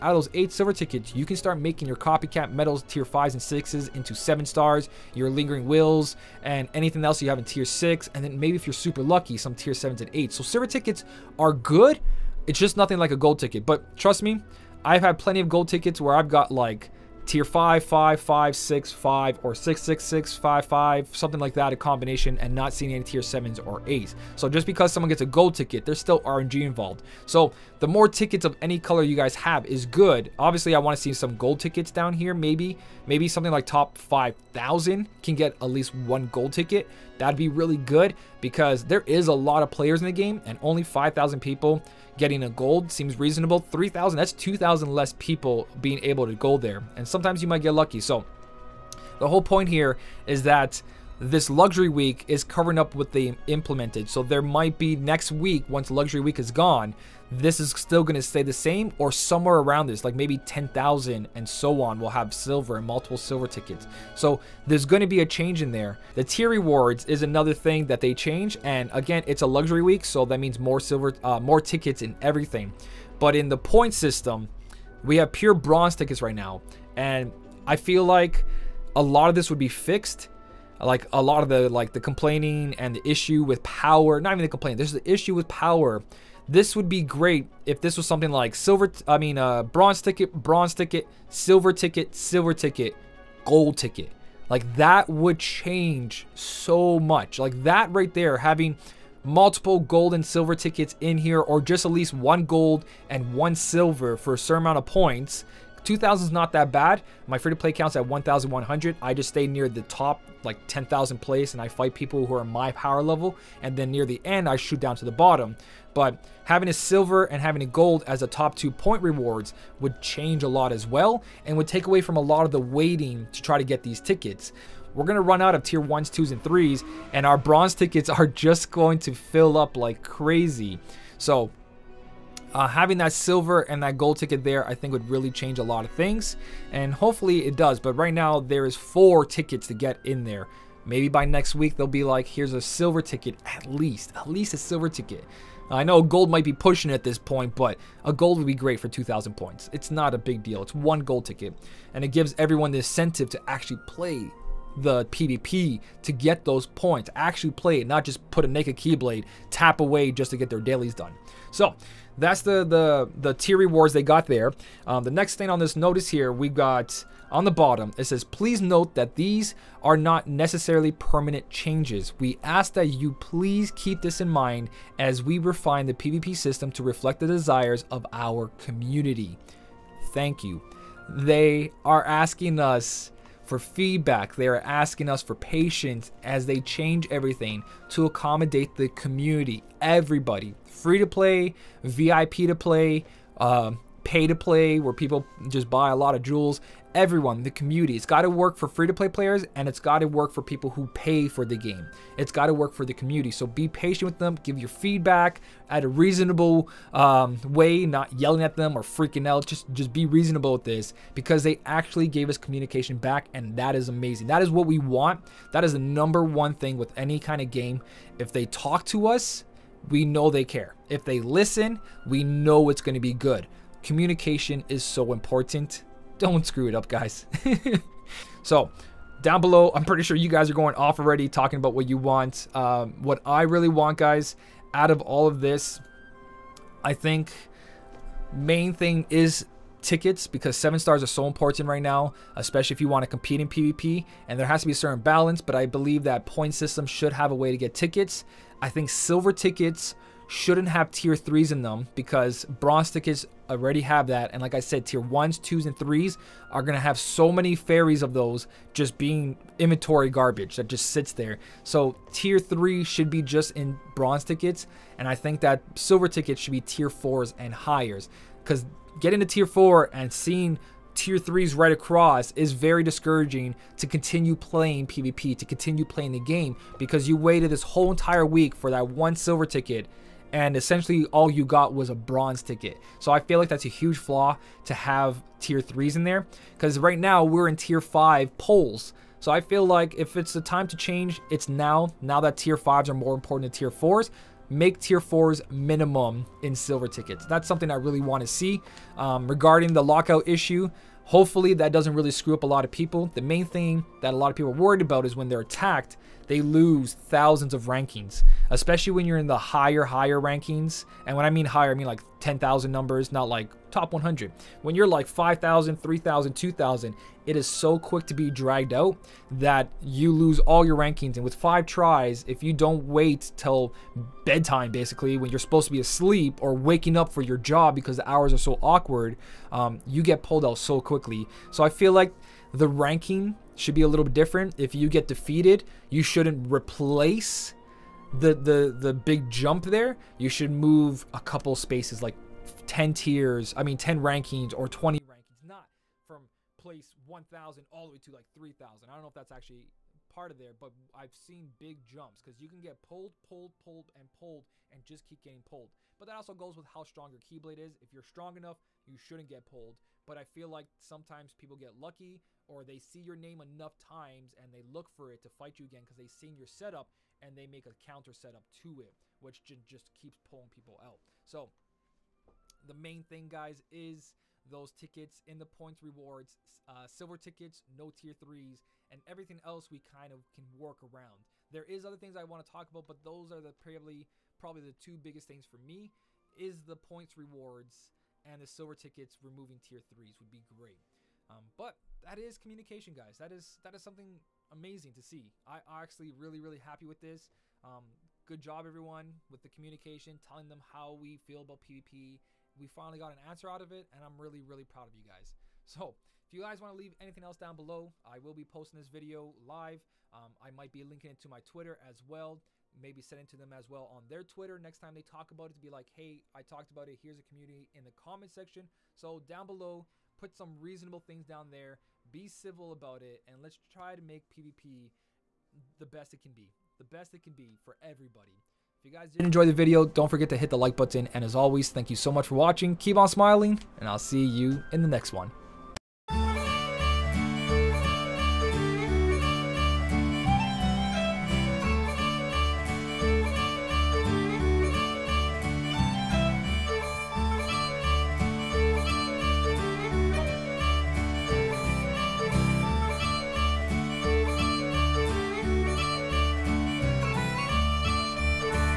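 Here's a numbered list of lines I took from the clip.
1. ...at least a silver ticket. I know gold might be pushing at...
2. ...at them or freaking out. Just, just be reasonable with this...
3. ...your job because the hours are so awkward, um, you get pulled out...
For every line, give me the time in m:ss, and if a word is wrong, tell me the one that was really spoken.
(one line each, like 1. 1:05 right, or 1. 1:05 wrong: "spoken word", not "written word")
1. 2:24 right
2. 3:28 right
3. 5:27 right.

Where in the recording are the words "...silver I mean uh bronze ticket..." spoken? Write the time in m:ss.
1:28.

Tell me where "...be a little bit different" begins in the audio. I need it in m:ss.
5:33.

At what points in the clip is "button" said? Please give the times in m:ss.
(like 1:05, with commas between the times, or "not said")
7:10.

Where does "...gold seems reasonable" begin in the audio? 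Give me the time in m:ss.
0:42.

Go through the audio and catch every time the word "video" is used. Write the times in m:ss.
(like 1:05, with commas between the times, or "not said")
6:48, 7:09.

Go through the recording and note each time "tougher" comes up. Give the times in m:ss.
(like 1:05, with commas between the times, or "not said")
not said.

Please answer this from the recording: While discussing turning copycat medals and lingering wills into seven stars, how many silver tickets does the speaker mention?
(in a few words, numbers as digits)
8.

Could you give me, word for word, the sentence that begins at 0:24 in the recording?
So just because someone gets a gold ticket, there's still RNG involved.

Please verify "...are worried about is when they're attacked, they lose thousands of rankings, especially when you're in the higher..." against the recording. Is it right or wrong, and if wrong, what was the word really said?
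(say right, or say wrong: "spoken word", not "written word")
right.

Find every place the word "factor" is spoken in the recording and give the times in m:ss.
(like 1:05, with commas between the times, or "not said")
not said.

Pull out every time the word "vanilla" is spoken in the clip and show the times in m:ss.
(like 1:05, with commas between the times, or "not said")
not said.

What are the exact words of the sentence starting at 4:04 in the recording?
And there has to be a certain balance, but I believe that point system should have a way to get tickets.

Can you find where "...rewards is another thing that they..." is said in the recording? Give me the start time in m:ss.
1:06.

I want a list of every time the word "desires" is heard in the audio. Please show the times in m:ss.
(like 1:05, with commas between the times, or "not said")
2:57.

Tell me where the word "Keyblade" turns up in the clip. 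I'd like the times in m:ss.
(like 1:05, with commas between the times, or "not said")
2:38, 5:57.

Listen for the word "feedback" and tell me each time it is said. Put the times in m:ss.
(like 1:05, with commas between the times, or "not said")
3:03, 3:24.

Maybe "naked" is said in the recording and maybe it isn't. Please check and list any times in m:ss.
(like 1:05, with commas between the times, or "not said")
2:38.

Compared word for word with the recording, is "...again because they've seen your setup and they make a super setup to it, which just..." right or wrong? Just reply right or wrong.
wrong.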